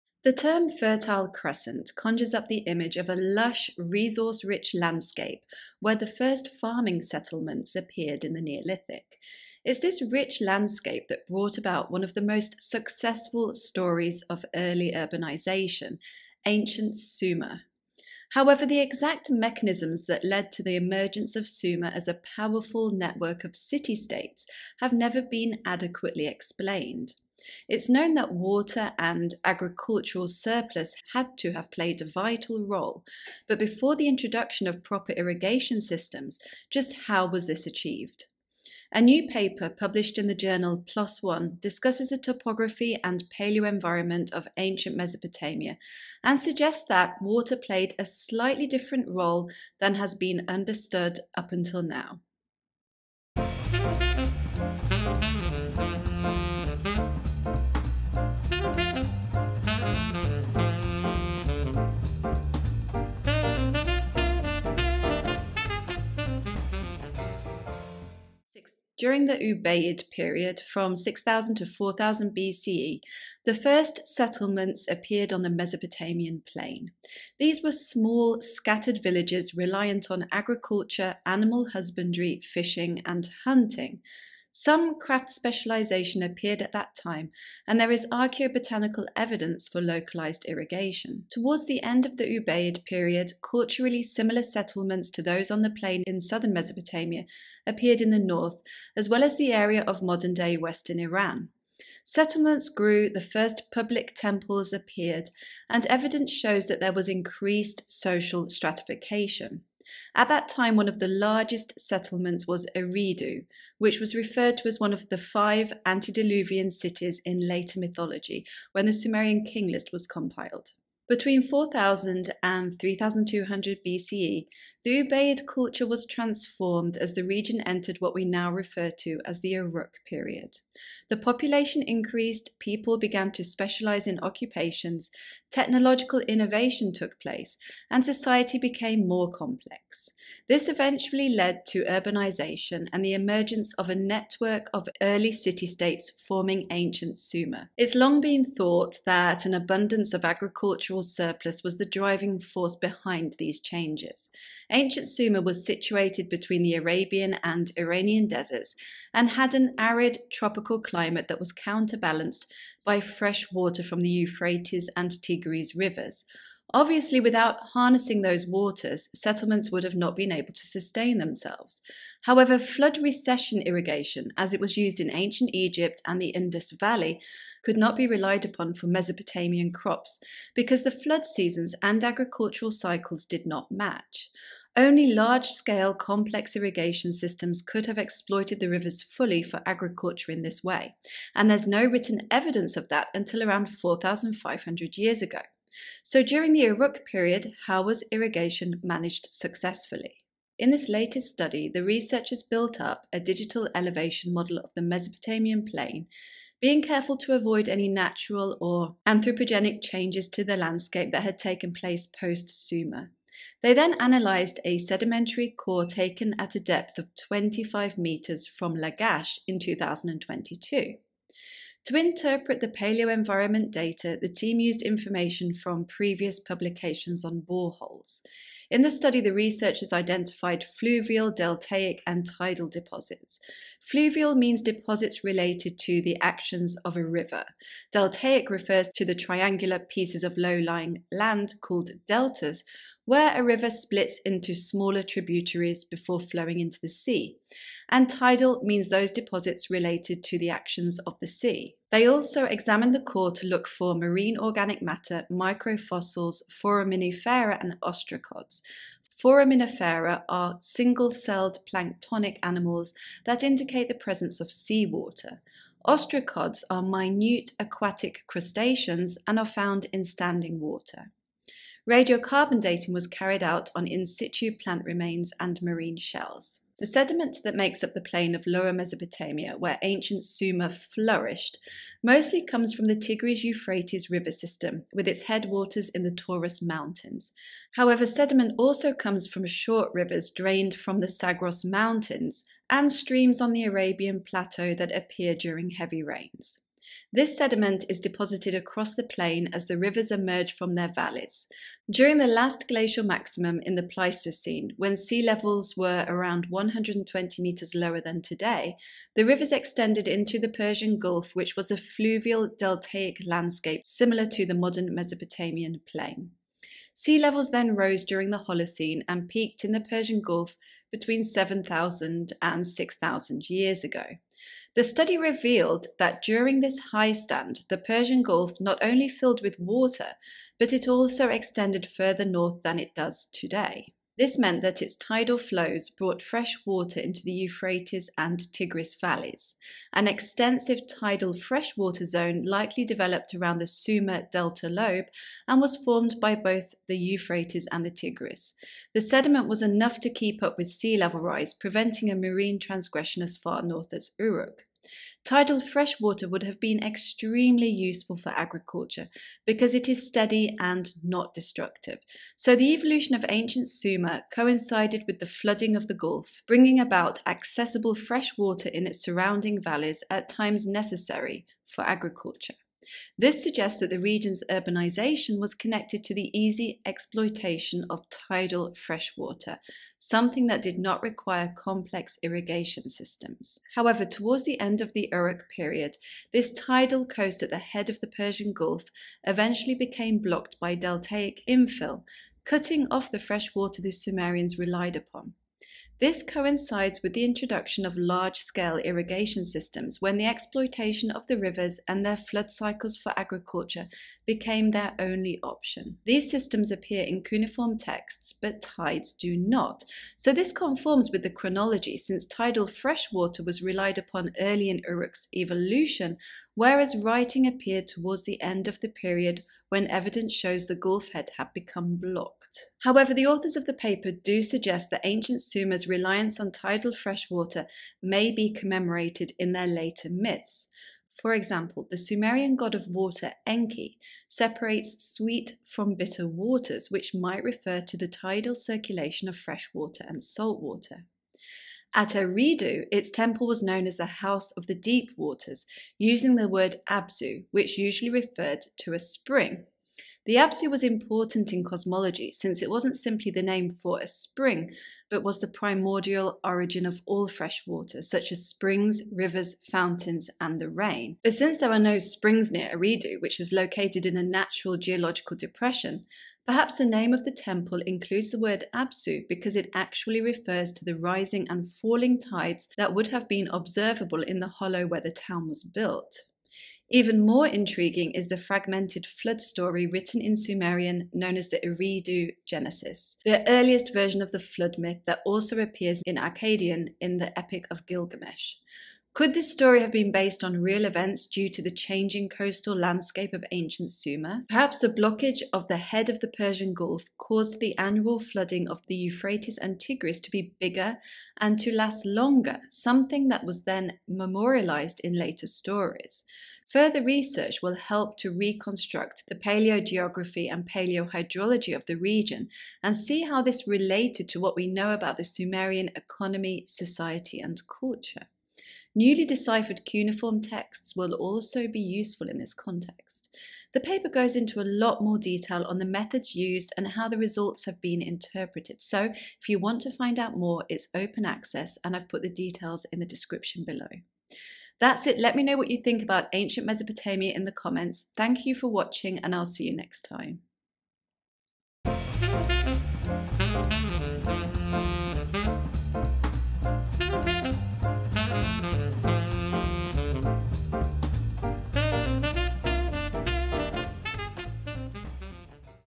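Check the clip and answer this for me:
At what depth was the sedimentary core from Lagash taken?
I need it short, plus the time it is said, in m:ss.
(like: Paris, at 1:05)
25 metres, at 3:37.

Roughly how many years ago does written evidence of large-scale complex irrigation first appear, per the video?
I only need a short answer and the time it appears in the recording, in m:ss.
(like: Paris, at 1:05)
4,500, at 3:13.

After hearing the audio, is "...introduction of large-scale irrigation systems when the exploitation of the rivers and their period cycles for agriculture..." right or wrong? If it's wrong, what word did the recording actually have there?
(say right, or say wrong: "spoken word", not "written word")
wrong: "flood", not "period".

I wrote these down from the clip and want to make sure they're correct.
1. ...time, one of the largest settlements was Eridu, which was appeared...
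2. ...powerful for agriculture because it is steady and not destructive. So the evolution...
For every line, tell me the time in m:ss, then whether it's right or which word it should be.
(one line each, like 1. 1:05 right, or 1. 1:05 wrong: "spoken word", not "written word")
1. 1:50 wrong: "referred", not "appeared"
2. 5:57 wrong: "useful", not "powerful".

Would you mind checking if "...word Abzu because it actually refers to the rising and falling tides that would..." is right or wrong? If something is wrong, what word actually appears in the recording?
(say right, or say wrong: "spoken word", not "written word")
right.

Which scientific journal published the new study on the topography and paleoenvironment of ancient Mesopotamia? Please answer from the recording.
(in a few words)
PLOS ONE.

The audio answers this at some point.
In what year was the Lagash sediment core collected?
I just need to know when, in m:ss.
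3:39.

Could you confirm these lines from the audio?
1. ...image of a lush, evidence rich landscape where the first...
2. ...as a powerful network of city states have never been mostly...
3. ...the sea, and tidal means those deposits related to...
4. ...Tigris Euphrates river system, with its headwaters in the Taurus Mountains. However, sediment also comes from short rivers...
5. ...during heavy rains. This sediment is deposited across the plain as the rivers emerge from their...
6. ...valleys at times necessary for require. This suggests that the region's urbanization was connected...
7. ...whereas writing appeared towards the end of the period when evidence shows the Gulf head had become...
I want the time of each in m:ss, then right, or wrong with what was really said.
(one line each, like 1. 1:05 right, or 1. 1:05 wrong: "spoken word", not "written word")
1. 0:02 wrong: "resource", not "evidence"
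2. 0:21 wrong: "adequately", not "mostly"
3. 4:06 right
4. 4:42 right
5. 4:55 right
6. 6:09 wrong: "agriculture", not "require"
7. 6:56 right.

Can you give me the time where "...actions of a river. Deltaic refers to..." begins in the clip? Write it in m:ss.
3:56.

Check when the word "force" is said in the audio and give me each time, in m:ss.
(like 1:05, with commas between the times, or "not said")
2:32.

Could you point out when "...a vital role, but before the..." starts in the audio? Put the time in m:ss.
0:32.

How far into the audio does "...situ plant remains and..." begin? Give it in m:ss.
4:34.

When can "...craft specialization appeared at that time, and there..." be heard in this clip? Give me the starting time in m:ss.
1:24.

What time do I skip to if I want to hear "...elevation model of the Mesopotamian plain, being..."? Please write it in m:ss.
3:23.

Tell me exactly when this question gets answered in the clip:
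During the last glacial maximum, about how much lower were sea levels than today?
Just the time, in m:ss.
5:06.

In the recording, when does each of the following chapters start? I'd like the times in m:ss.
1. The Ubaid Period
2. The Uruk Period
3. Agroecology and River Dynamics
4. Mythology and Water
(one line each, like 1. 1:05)
1. 1:09
2. 2:01
3. 3:20
4. 7:02.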